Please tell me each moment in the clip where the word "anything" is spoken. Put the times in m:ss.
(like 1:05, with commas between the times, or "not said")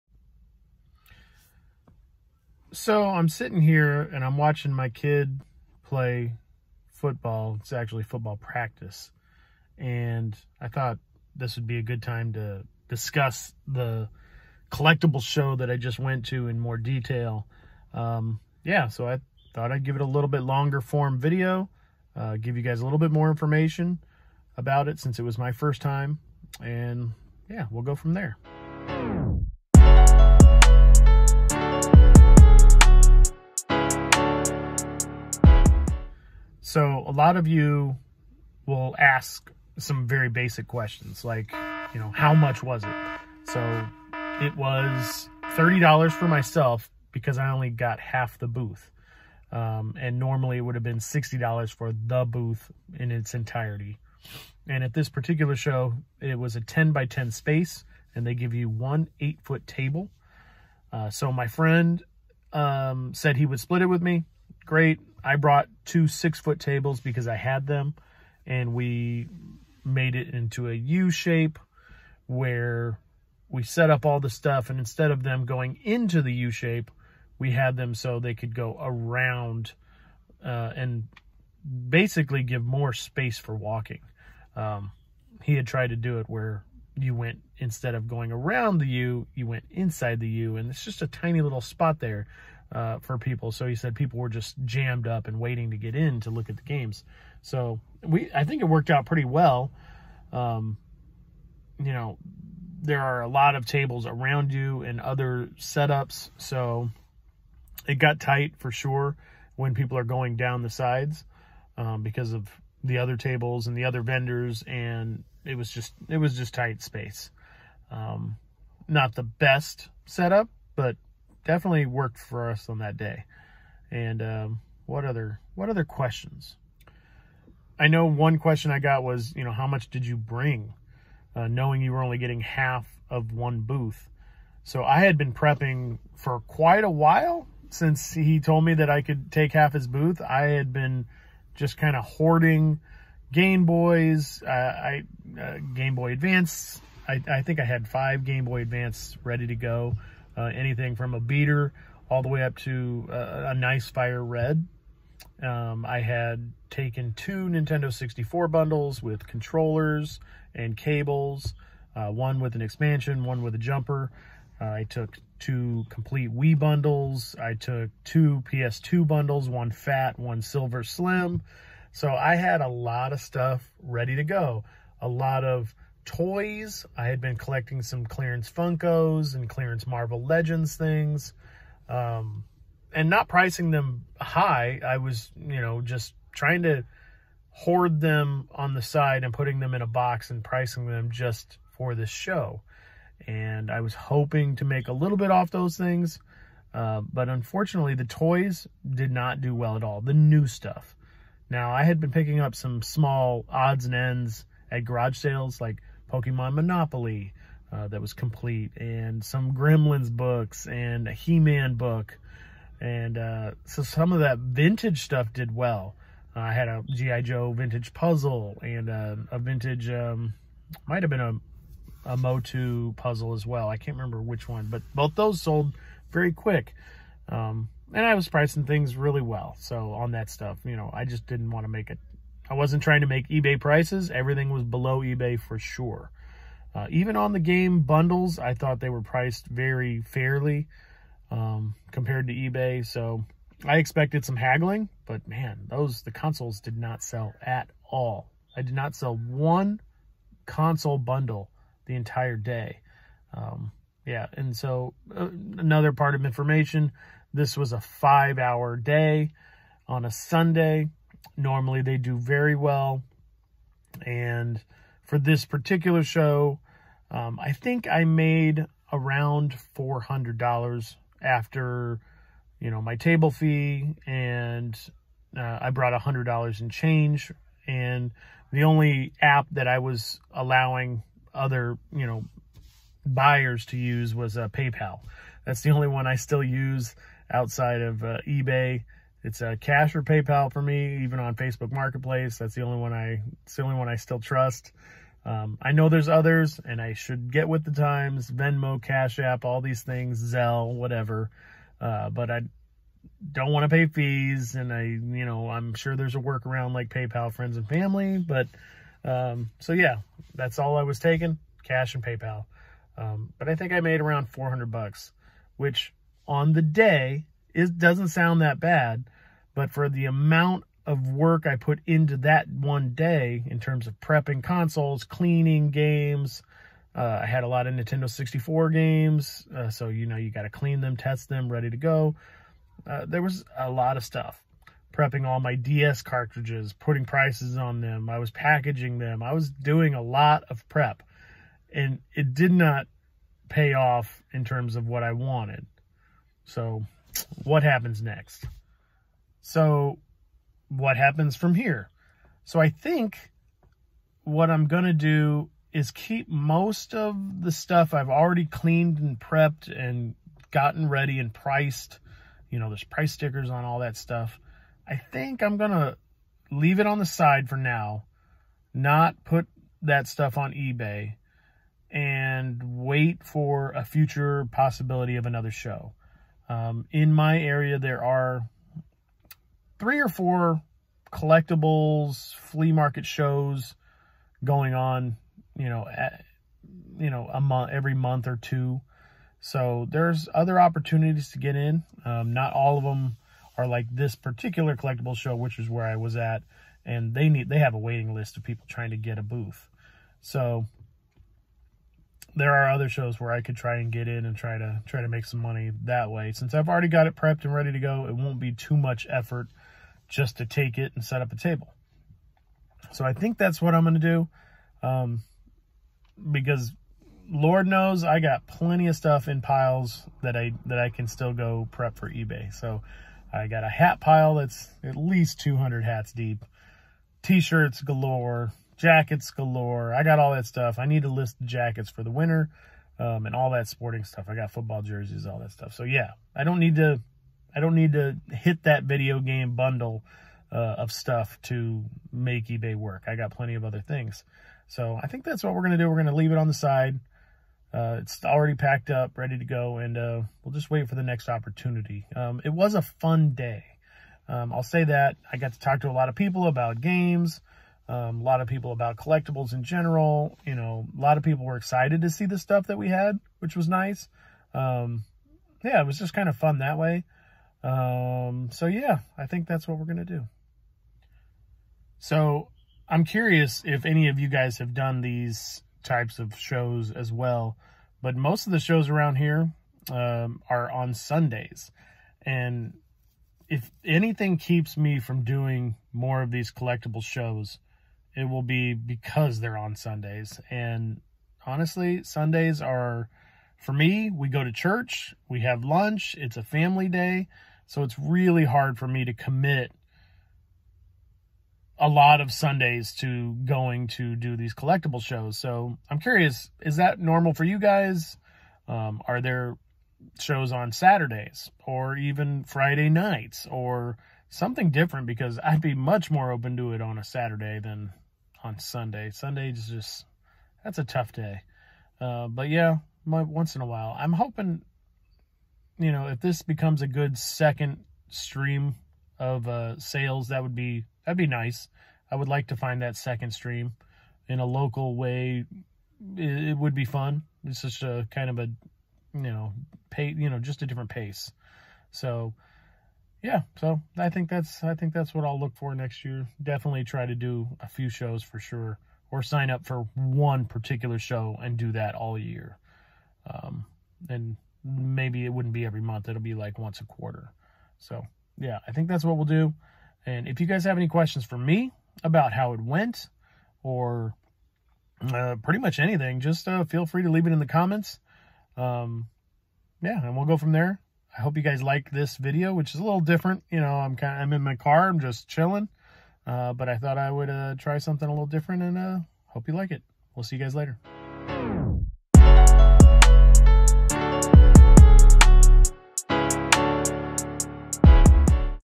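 2:30, 8:03, 9:25.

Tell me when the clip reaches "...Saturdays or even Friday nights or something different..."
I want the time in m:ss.
8:30.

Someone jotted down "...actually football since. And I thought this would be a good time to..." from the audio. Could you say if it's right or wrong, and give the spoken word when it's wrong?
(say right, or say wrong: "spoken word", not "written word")
wrong: "practice", not "since".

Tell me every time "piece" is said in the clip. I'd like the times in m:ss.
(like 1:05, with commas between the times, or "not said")
not said.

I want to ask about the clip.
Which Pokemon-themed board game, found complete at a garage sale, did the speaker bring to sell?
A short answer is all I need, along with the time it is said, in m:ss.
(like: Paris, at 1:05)
Pokemon Monopoly, at 3:26.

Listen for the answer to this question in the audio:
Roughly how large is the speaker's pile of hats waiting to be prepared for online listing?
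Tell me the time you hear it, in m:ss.
7:05.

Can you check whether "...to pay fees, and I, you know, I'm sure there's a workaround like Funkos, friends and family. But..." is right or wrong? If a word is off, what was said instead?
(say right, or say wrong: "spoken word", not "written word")
wrong: "PayPal", not "Funkos".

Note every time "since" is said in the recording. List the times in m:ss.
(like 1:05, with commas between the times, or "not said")
0:24, 2:17, 6:46.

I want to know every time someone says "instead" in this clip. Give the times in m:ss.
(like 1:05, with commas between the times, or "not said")
1:14, 1:27.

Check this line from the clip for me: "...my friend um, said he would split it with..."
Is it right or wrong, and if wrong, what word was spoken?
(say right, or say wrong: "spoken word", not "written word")
right.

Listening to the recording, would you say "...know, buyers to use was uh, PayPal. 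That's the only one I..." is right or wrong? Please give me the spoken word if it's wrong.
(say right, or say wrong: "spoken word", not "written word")
right.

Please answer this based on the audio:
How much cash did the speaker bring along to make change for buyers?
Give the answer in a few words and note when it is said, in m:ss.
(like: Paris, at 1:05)
$100, at 4:35.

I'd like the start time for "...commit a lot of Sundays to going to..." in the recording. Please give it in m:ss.
8:19.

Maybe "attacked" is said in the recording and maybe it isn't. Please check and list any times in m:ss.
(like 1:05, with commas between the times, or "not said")
not said.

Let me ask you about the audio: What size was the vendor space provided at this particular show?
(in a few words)
10 by 10.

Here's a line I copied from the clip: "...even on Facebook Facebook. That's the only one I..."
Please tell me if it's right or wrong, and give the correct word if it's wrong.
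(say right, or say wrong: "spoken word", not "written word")
wrong: "Marketplace", not "Facebook".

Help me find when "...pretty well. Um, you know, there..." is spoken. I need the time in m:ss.
1:39.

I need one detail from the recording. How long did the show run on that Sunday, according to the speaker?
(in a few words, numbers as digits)
5 hours.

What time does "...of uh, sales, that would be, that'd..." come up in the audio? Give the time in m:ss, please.
8:49.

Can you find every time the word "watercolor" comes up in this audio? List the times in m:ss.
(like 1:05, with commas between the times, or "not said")
not said.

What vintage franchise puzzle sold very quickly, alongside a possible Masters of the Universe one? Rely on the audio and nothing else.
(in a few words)
G.I. Joe.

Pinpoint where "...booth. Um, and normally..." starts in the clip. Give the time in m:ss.
0:48.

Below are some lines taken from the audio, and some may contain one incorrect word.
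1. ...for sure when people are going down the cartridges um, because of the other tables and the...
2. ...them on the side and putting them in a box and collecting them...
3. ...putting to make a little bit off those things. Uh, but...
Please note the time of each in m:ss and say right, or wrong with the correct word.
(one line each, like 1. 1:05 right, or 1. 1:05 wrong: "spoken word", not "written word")
1. 1:48 wrong: "sides", not "cartridges"
2. 3:08 wrong: "pricing", not "collecting"
3. 3:13 wrong: "hoping", not "putting".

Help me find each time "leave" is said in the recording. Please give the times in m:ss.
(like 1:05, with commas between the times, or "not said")
6:06, 7:26, 9:27.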